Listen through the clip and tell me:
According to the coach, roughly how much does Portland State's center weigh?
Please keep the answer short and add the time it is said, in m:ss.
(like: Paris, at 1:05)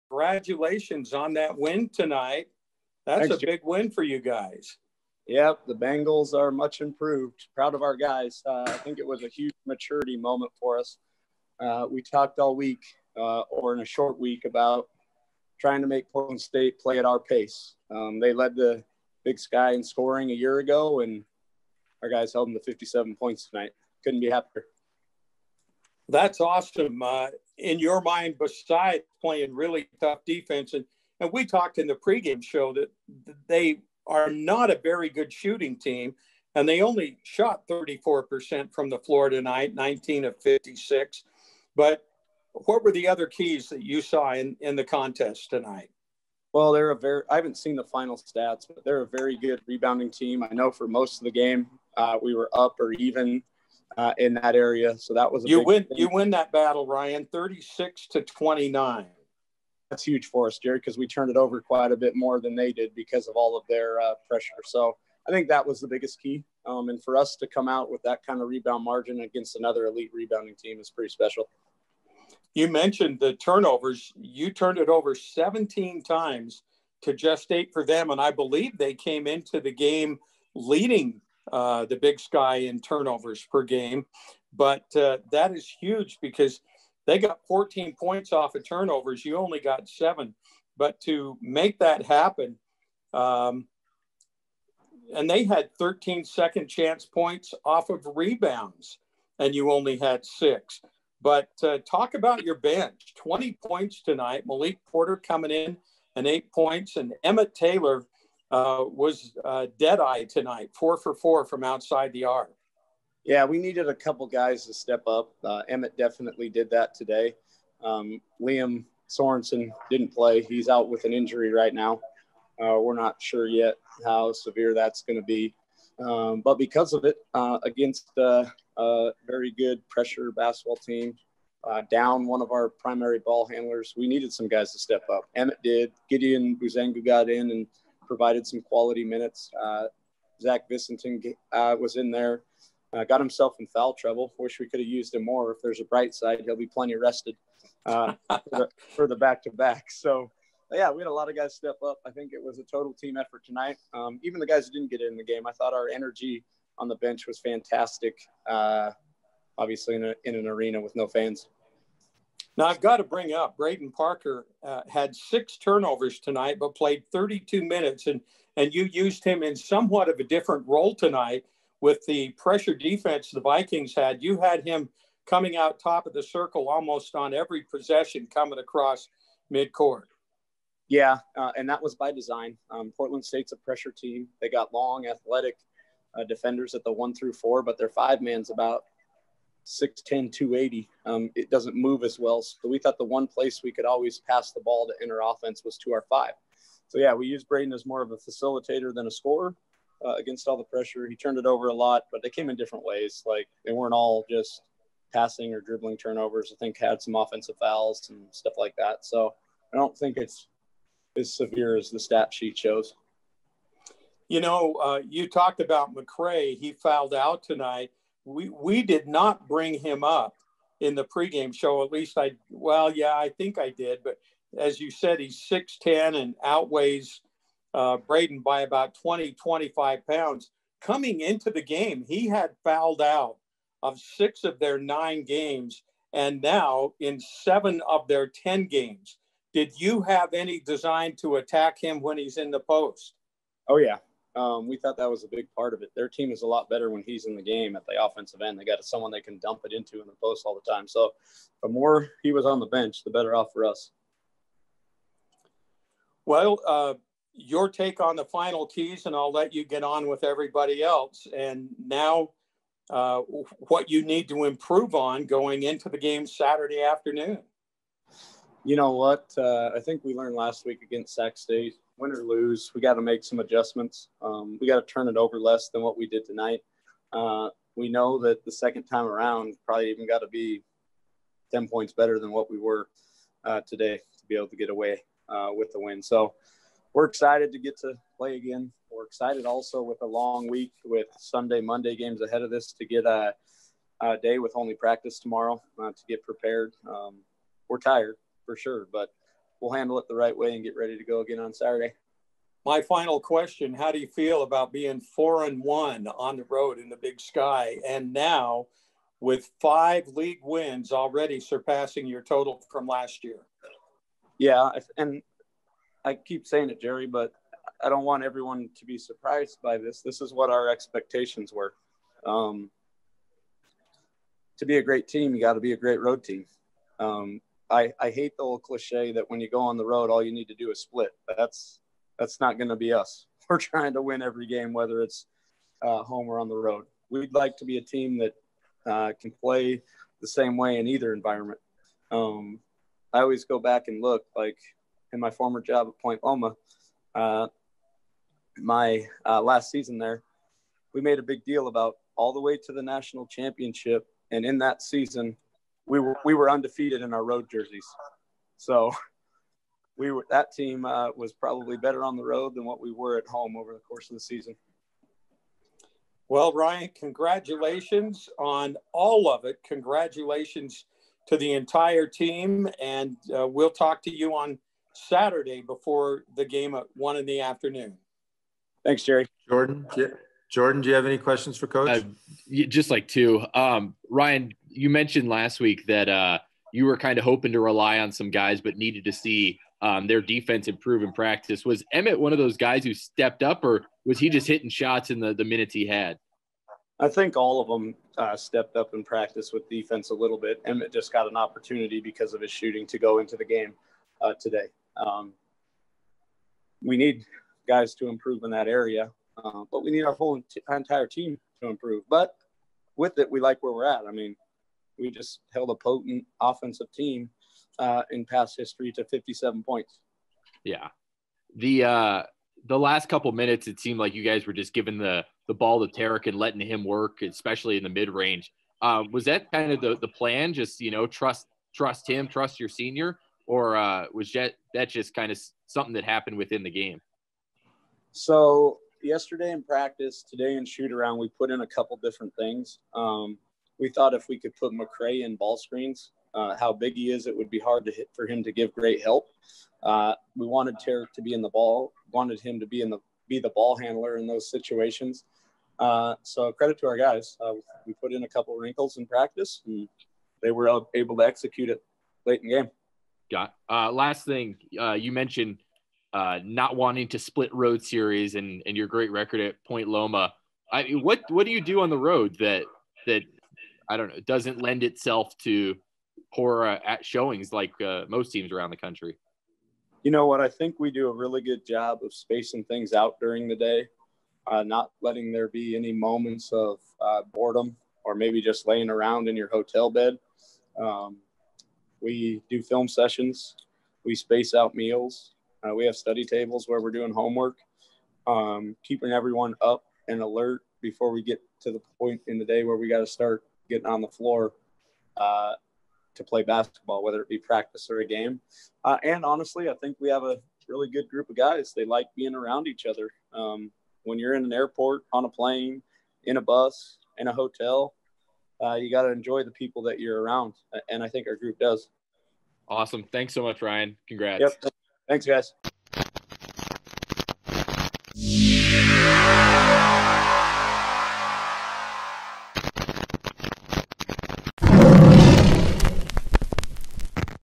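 280, at 3:10.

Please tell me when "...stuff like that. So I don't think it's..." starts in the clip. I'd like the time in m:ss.
3:28.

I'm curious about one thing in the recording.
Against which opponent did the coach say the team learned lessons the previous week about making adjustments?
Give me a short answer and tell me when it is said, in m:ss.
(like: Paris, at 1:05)
Sac State, at 4:31.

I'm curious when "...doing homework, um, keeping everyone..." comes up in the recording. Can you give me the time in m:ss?
8:16.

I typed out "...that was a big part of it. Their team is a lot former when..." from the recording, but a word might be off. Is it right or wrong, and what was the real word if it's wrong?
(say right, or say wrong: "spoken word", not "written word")
wrong: "better", not "former".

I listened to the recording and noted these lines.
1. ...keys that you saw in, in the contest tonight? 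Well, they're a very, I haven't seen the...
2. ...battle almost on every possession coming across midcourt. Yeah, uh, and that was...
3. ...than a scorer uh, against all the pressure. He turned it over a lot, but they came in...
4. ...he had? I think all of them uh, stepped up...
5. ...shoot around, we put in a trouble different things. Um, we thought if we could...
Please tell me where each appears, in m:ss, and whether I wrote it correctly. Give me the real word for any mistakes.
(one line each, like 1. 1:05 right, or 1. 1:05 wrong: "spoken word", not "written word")
1. 0:43 right
2. 2:56 wrong: "circle", not "battle"
3. 3:18 right
4. 6:35 right
5. 7:20 wrong: "couple", not "trouble".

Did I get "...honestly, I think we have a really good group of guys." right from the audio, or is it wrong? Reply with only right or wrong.
right.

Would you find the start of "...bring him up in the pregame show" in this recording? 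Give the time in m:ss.
3:39.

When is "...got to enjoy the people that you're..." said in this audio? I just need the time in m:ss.
8:38.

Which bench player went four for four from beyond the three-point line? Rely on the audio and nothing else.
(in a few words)
Emmett Taylor.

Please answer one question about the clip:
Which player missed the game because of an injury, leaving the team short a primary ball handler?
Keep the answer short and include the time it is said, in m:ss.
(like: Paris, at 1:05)
Liam Sorensen, at 1:58.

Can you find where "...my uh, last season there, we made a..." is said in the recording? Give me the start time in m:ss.
5:48.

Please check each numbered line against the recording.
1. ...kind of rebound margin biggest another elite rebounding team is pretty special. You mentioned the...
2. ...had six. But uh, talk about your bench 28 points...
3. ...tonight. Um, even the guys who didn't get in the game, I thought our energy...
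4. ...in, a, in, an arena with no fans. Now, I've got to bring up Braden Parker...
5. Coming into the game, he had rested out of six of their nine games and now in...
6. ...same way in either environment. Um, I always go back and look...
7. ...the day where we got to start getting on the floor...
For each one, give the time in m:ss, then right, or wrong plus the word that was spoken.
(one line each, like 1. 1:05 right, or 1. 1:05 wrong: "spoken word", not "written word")
1. 1:08 wrong: "against", not "biggest"
2. 1:39 wrong: "20", not "28"
3. 2:33 right
4. 2:39 right
5. 3:50 wrong: "fouled", not "rested"
6. 5:40 right
7. 8:22 right.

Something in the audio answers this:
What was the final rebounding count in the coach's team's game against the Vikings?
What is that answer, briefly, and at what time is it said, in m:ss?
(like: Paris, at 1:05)
36 to 29, at 0:57.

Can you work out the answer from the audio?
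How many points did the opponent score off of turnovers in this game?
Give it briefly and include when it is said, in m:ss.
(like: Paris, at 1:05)
14, at 1:27.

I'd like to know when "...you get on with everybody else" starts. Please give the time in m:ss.
4:19.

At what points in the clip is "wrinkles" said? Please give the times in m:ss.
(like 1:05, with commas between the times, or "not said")
7:38.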